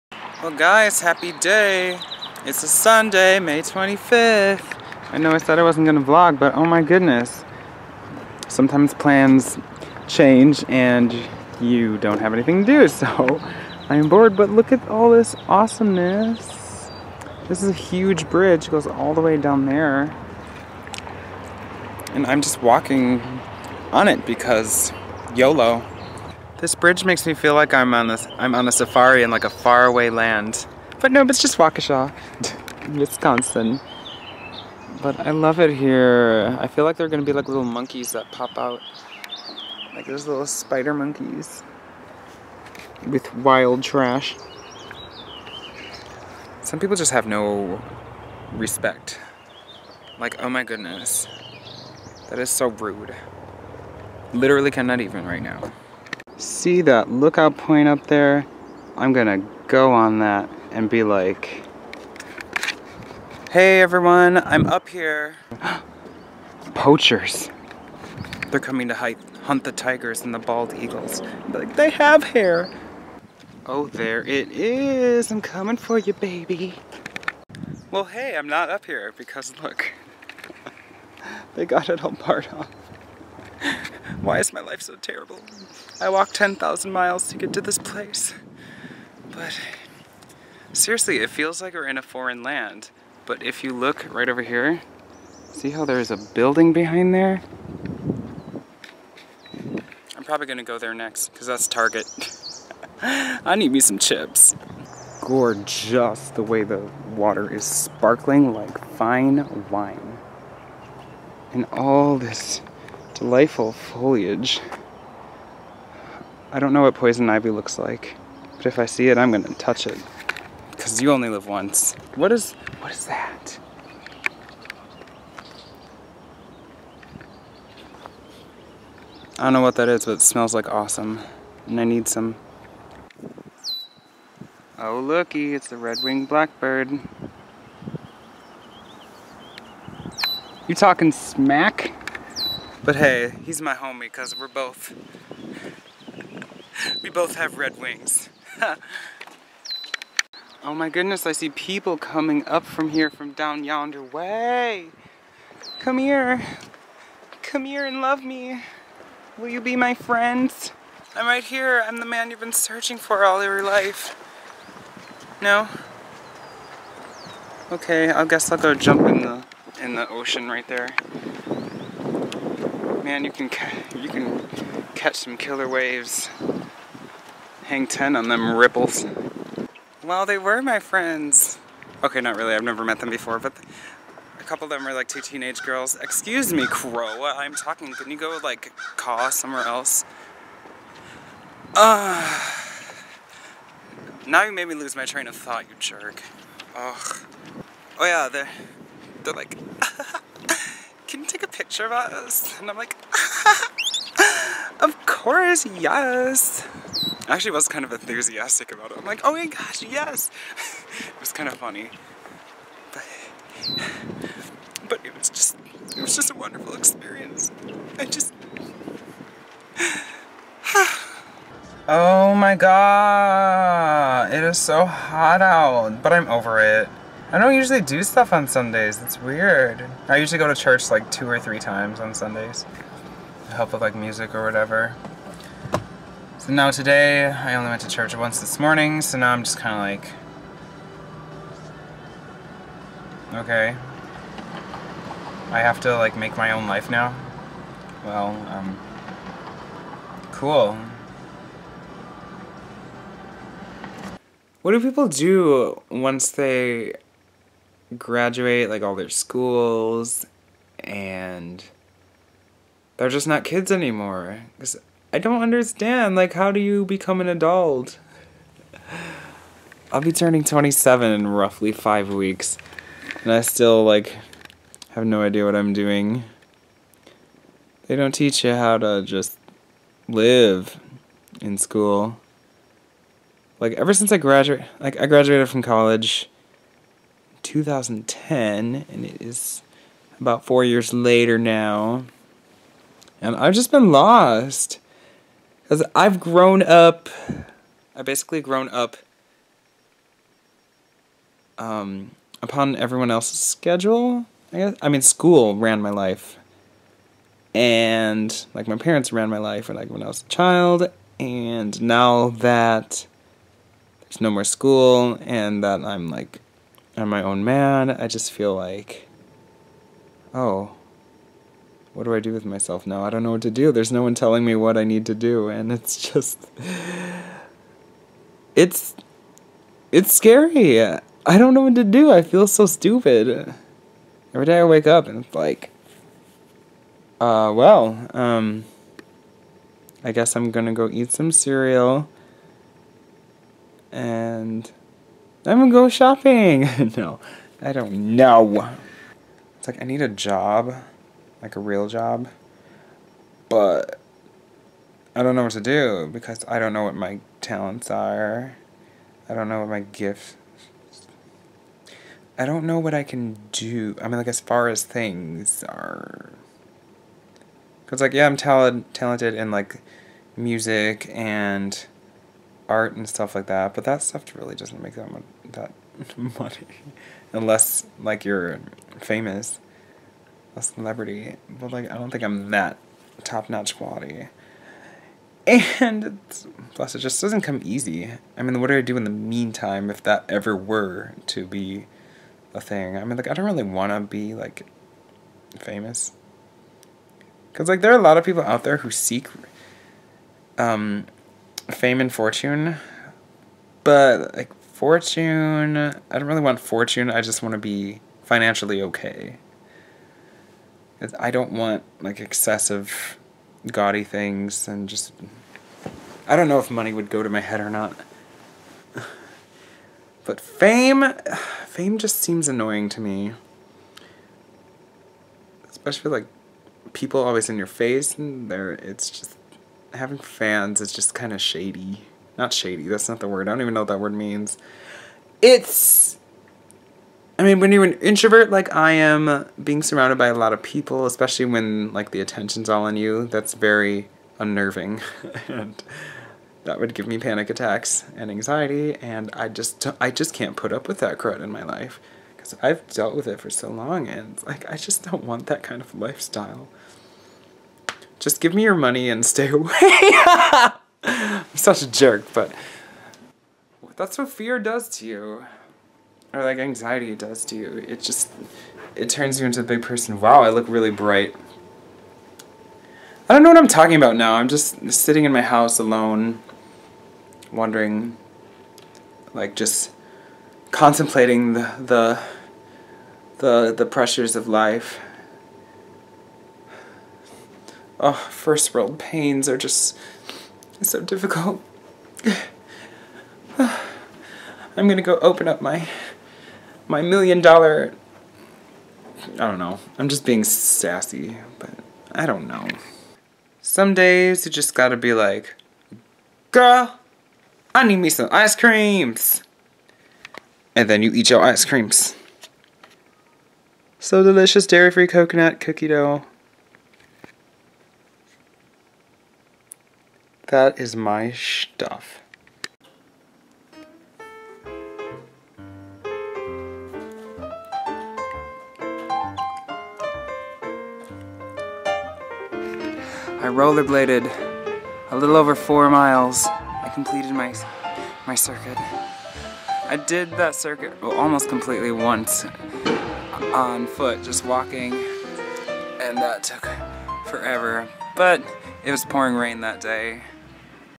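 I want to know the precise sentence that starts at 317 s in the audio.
I just feel like, oh, what do I do with myself now?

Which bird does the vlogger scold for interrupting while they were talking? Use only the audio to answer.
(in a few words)
Crow.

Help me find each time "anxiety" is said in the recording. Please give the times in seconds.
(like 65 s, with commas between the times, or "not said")
448 s, 466 s.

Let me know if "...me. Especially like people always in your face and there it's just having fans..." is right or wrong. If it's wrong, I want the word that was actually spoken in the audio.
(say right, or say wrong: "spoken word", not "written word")
right.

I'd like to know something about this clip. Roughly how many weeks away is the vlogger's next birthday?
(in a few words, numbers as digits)
5.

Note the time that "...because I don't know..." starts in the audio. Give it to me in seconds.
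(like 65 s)
356 s.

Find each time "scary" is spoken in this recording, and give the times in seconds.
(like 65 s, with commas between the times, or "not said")
330 s.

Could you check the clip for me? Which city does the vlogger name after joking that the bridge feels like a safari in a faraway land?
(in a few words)
Waukesha.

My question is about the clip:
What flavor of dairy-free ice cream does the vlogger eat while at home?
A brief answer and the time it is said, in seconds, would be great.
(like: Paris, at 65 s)
coconut cookie dough, at 515 s.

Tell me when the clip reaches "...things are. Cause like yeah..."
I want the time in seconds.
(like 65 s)
364 s.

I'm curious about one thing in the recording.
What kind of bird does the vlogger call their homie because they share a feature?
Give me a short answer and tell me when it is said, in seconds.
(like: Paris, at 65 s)
red-winged blackbird, at 135 s.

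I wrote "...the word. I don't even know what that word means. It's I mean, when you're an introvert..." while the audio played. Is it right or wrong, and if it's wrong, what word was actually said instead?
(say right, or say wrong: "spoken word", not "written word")
right.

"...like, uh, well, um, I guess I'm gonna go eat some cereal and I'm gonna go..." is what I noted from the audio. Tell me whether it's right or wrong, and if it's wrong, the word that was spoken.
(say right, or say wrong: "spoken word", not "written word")
right.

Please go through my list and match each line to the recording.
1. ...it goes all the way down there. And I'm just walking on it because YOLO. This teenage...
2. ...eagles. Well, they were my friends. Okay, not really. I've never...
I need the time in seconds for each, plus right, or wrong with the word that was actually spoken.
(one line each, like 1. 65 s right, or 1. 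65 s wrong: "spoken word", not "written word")
1. 18 s wrong: "bridge", not "teenage"
2. 178 s wrong: "ripples", not "eagles".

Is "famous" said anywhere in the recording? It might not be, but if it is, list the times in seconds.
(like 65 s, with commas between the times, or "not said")
378 s, 395 s.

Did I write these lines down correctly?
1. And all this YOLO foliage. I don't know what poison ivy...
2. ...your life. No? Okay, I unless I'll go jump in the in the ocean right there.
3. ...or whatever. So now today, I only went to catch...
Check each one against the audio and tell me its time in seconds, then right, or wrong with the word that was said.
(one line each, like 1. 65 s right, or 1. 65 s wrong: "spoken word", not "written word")
1. 111 s wrong: "Delightful", not "YOLO"
2. 163 s wrong: "guess", not "unless"
3. 234 s wrong: "church", not "catch".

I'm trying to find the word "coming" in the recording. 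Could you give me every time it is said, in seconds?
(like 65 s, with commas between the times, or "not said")
68 s, 75 s, 151 s.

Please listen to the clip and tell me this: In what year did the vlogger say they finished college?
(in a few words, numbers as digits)
2010.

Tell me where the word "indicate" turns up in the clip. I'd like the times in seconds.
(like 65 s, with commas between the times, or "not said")
not said.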